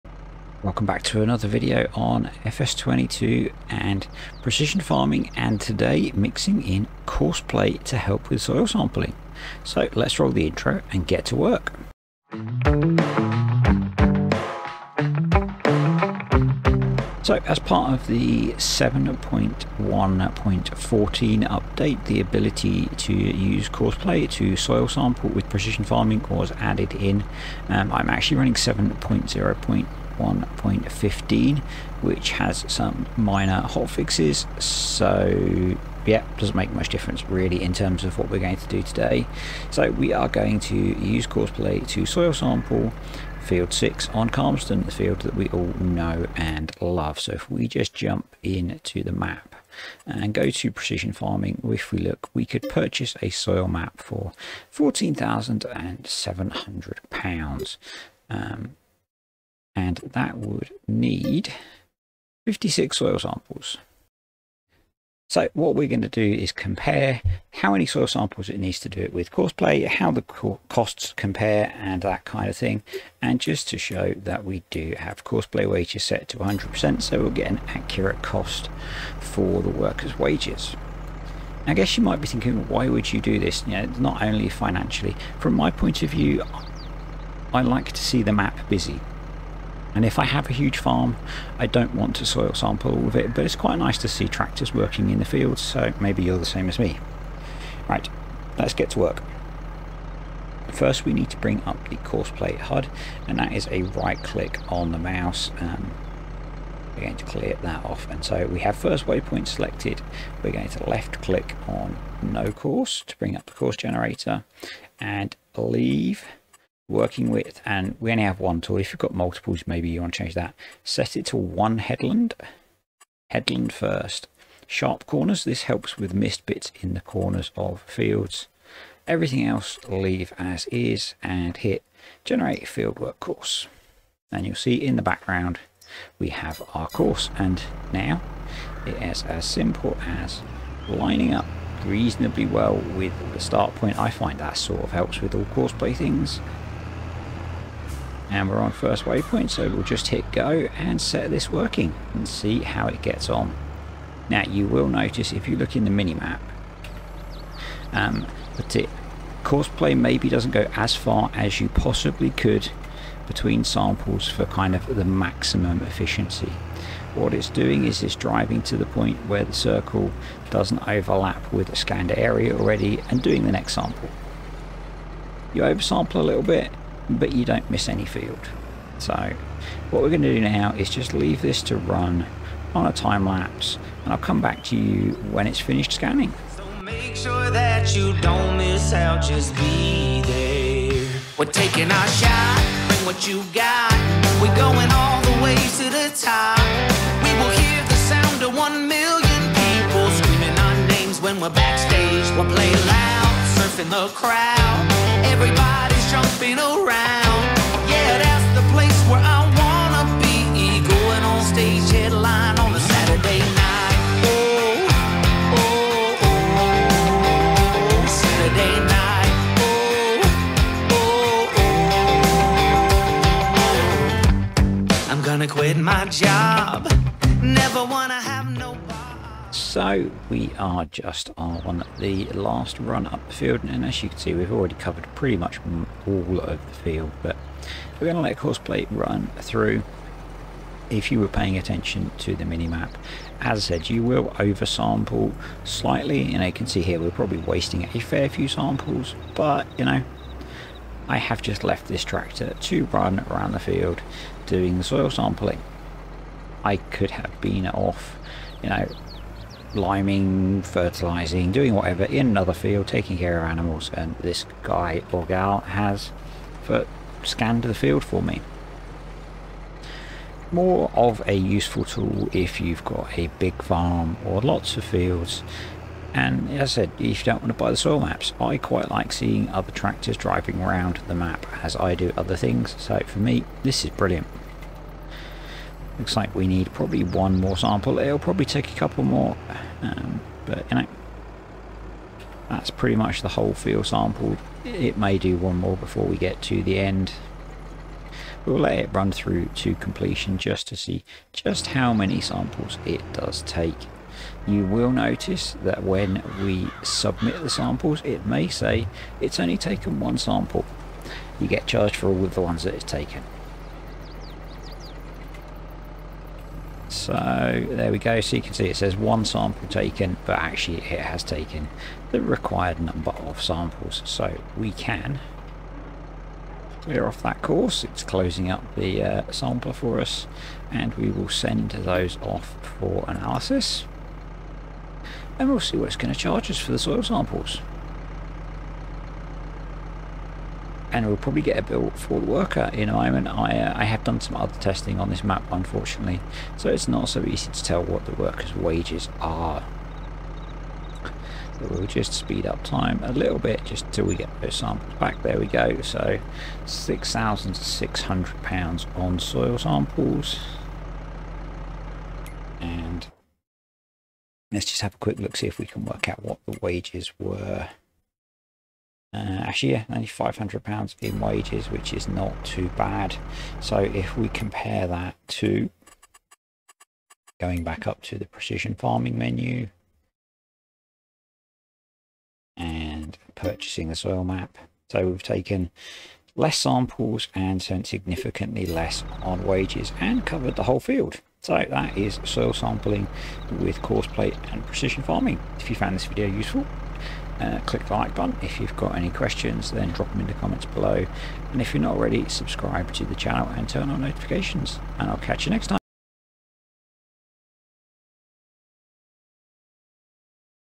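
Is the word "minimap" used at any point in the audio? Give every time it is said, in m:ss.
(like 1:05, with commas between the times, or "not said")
2:35, 4:02.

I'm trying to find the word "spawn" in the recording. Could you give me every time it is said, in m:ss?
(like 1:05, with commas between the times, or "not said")
not said.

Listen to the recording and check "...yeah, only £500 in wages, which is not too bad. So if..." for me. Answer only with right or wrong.
right.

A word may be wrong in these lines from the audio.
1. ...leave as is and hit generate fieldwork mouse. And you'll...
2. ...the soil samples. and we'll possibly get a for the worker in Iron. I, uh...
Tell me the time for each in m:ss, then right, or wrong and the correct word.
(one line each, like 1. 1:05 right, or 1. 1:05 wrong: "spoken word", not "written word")
1. 2:09 wrong: "course", not "mouse"
2. 5:36 wrong: "probably", not "possibly".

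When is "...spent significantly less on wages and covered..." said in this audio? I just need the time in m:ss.
6:27.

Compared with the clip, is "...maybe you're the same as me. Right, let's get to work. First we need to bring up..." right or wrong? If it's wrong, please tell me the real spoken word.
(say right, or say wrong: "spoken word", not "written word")
right.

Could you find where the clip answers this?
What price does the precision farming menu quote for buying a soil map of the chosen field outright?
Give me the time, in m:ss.
0:54.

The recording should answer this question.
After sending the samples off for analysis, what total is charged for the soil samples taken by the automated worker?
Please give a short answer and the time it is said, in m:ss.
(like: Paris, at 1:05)
£6,600, at 5:56.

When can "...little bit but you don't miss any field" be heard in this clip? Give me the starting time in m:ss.
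2:56.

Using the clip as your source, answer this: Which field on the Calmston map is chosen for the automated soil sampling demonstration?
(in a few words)
Field 6.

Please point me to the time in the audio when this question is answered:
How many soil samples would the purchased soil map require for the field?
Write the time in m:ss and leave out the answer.
1:02.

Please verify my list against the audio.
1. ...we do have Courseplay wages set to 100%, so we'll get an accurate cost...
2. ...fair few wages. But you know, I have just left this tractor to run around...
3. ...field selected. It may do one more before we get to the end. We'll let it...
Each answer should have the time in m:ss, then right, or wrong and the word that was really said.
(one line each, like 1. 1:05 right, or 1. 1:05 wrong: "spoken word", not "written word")
1. 1:14 right
2. 4:07 wrong: "samples", not "wages"
3. 4:53 wrong: "sampled", not "selected".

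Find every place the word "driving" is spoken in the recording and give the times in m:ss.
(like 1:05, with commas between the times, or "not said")
2:48, 4:40.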